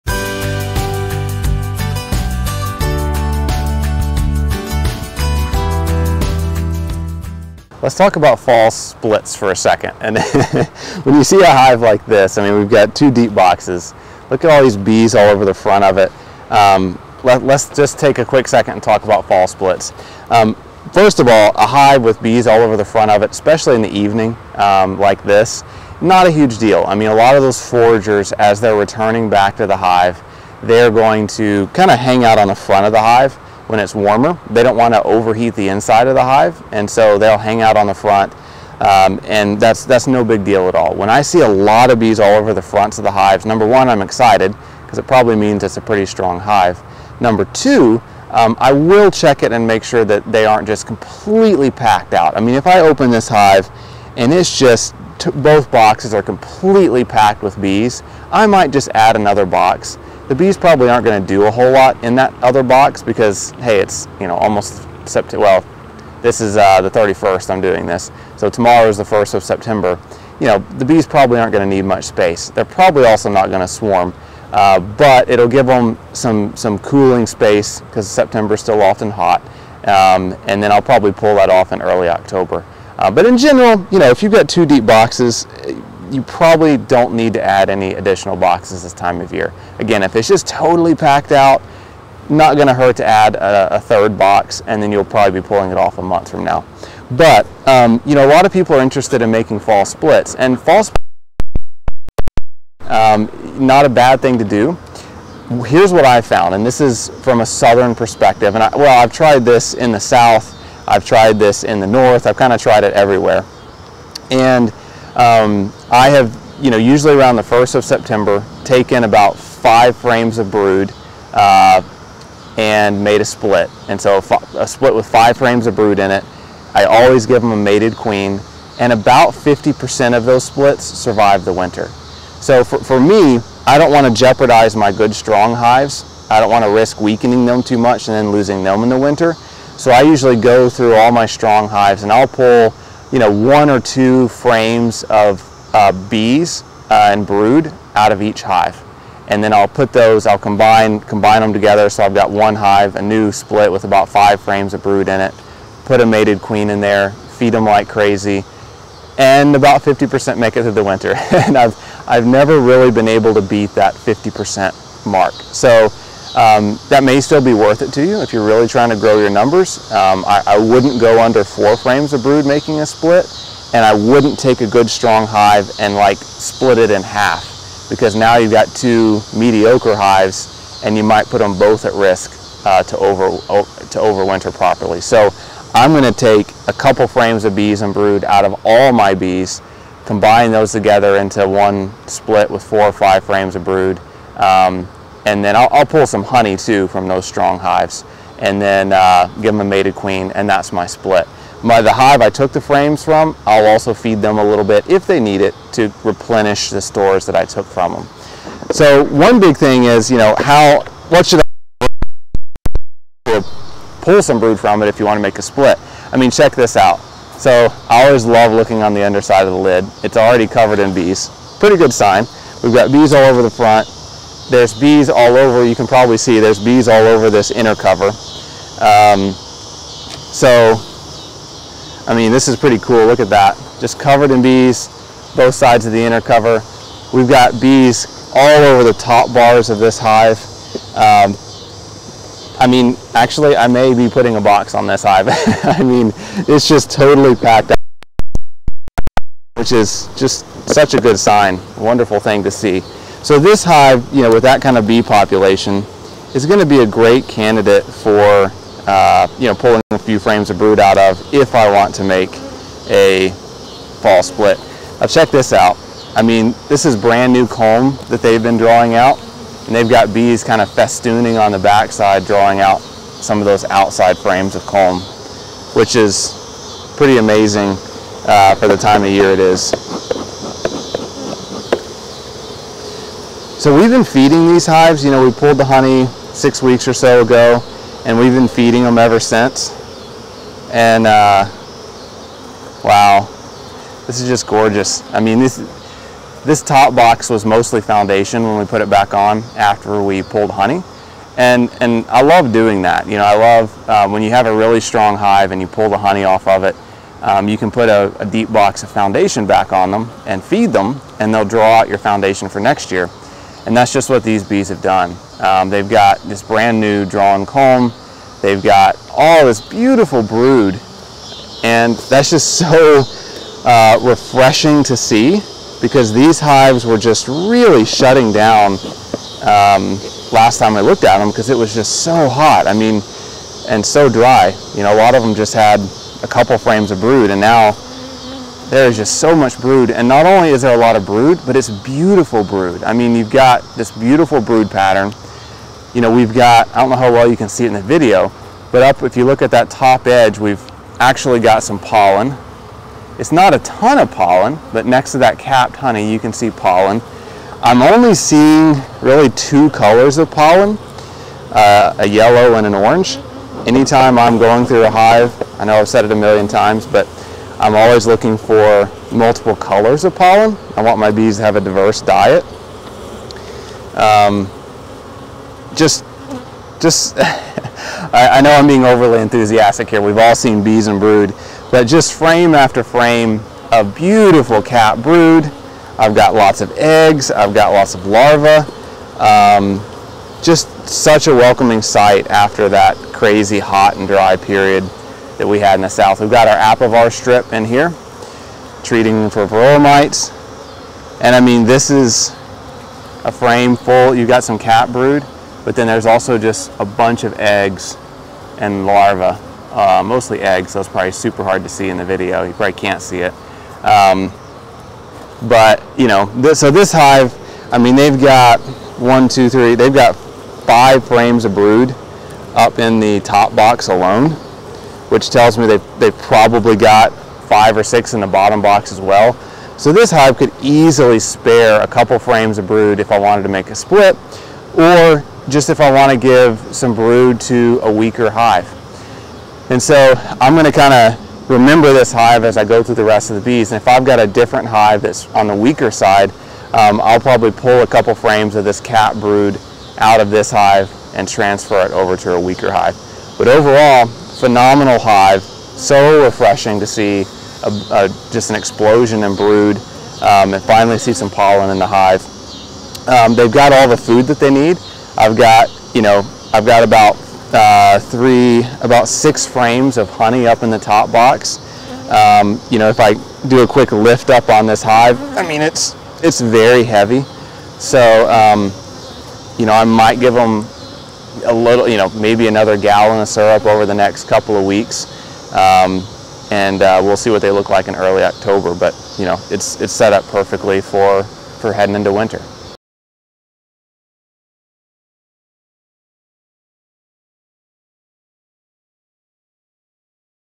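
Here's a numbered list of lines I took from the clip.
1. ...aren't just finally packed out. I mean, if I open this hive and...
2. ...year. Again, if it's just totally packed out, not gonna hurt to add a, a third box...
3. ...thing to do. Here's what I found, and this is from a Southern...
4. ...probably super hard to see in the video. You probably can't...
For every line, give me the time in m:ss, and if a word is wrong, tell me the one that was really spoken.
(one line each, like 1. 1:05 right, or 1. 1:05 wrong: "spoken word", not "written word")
1. 0:50 wrong: "completely", not "finally"
2. 1:29 right
3. 1:44 right
4. 6:50 right.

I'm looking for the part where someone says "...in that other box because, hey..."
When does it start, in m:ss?
1:02.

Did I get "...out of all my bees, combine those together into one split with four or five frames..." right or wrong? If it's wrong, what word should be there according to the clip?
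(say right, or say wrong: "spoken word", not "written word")
right.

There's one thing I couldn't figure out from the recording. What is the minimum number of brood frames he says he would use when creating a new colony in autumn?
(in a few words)
4.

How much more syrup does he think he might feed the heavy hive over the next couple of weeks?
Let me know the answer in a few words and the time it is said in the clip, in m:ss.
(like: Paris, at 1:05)
1 gallon, at 8:02.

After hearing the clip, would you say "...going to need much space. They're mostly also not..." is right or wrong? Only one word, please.
wrong.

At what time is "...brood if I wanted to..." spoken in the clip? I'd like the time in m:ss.
7:12.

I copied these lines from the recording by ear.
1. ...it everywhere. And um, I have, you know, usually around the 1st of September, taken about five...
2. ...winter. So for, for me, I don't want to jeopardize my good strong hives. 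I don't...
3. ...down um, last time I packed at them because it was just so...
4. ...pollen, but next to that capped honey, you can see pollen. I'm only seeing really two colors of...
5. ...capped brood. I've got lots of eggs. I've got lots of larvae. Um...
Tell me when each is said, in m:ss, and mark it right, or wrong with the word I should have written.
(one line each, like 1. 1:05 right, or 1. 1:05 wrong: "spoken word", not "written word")
1. 1:52 right
2. 2:11 right
3. 5:28 wrong: "looked", not "packed"
4. 5:54 right
5. 6:24 right.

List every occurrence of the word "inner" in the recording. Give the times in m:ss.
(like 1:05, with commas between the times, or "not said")
3:47, 3:56.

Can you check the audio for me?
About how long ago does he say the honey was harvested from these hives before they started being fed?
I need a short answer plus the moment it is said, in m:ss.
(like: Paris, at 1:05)
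six weeks, at 4:46.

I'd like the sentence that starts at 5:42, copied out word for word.
I mean, you've got this beautiful brood pattern.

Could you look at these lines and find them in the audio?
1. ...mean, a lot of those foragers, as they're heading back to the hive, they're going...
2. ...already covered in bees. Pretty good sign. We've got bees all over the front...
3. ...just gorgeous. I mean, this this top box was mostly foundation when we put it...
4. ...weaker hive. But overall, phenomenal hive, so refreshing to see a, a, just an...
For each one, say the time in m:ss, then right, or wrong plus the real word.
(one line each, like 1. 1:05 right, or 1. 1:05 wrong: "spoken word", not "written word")
1. 0:26 wrong: "returning", not "heading"
2. 3:40 right
3. 4:54 right
4. 7:32 right.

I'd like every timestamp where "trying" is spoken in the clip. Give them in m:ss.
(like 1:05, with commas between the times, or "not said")
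2:48.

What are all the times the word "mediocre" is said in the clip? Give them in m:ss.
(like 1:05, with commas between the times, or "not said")
2:59.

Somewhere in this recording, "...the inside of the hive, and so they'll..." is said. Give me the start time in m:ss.
0:35.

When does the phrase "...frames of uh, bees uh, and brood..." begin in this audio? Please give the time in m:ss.
2:24.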